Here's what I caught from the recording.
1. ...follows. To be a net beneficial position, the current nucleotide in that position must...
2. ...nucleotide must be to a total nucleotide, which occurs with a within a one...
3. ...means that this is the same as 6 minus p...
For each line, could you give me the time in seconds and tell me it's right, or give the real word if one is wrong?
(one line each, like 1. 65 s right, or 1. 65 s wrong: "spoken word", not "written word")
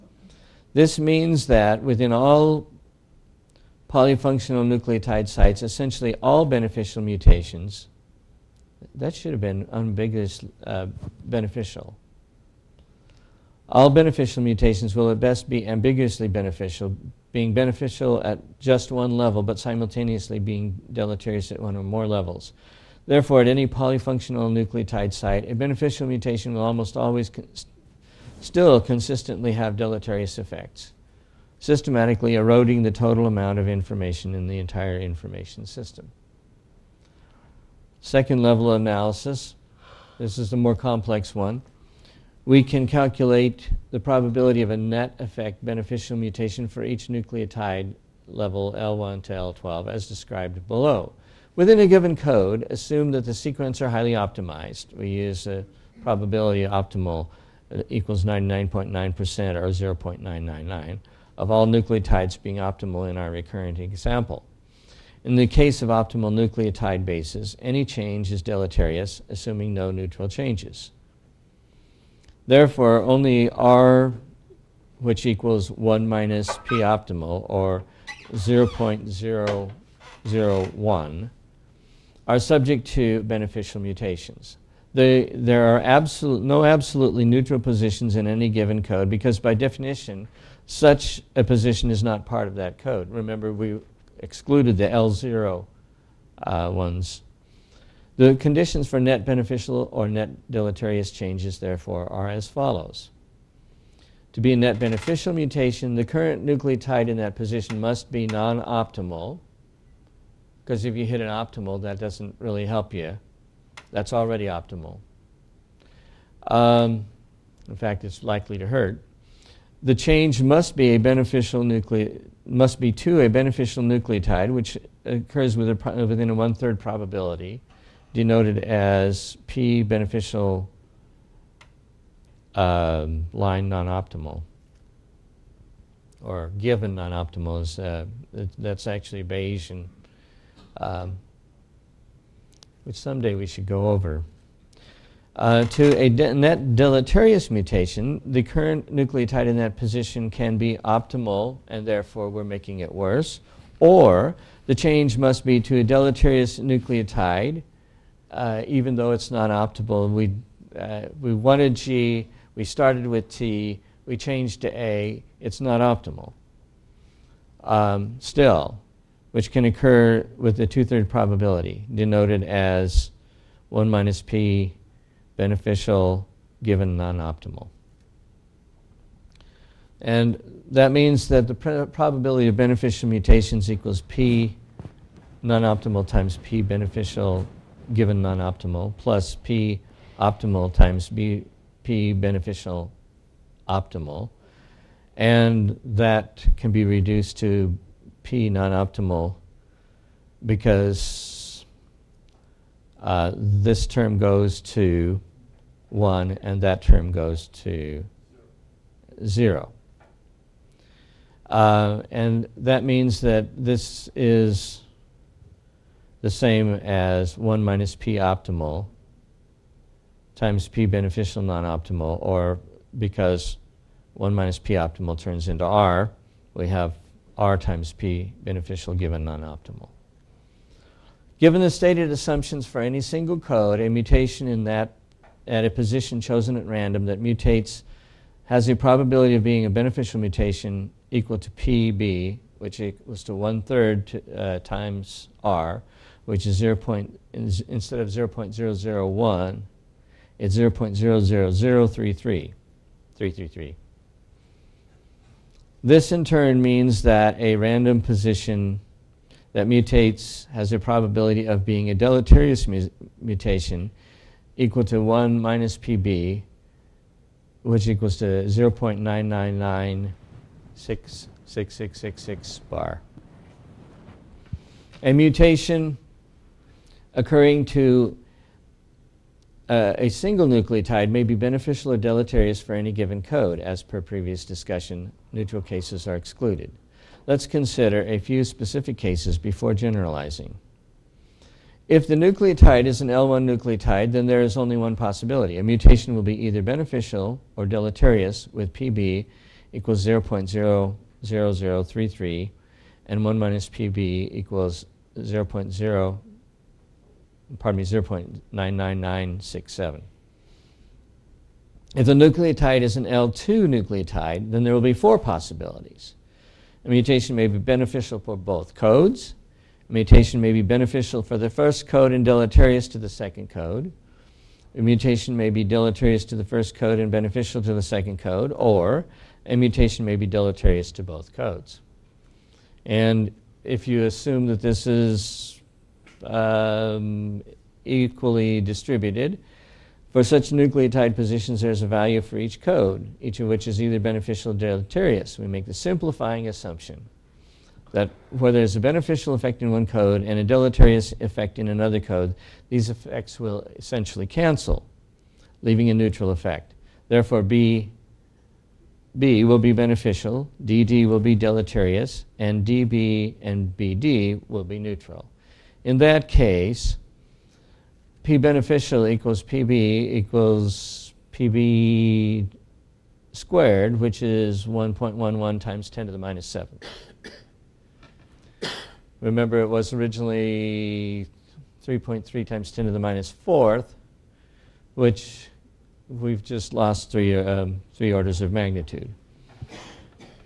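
1. 102 s wrong: "mutation", not "position"
2. 121 s wrong: "beneficial", not "total"
3. 212 s wrong: "1", not "6".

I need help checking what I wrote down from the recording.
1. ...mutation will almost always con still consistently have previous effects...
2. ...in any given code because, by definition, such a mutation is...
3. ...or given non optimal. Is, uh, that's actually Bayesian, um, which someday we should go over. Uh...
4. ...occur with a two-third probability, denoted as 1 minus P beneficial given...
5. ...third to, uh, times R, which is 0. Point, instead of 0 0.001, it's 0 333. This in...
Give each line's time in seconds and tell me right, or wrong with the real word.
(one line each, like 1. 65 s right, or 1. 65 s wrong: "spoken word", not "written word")
1. 26 s wrong: "deleterious", not "previous"
2. 88 s wrong: "position", not "mutation"
3. 136 s right
4. 169 s right
5. 243 s right.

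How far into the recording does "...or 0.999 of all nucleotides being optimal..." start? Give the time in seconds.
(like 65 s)
59 s.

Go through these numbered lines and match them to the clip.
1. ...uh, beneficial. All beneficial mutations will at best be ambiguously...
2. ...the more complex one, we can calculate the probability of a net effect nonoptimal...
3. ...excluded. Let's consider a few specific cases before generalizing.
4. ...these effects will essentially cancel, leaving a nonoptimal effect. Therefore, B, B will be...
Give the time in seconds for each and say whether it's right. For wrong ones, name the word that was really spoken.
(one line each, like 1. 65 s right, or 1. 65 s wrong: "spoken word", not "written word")
1. 10 s right
2. 40 s wrong: "beneficial", not "nonoptimal"
3. 286 s right
4. 352 s wrong: "neutral", not "nonoptimal".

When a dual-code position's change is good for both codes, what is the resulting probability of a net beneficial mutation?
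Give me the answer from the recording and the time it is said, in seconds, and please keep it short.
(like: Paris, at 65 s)
1.11 times 10^-7, at 374 s.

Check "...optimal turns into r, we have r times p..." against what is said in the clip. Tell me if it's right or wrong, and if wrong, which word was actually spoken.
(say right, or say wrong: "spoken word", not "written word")
right.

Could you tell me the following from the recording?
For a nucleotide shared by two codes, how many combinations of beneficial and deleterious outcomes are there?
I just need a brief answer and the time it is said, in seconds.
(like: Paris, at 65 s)
4, at 314 s.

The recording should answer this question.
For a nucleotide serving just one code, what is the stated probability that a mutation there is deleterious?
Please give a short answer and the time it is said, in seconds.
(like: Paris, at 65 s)
0.99967, at 307 s.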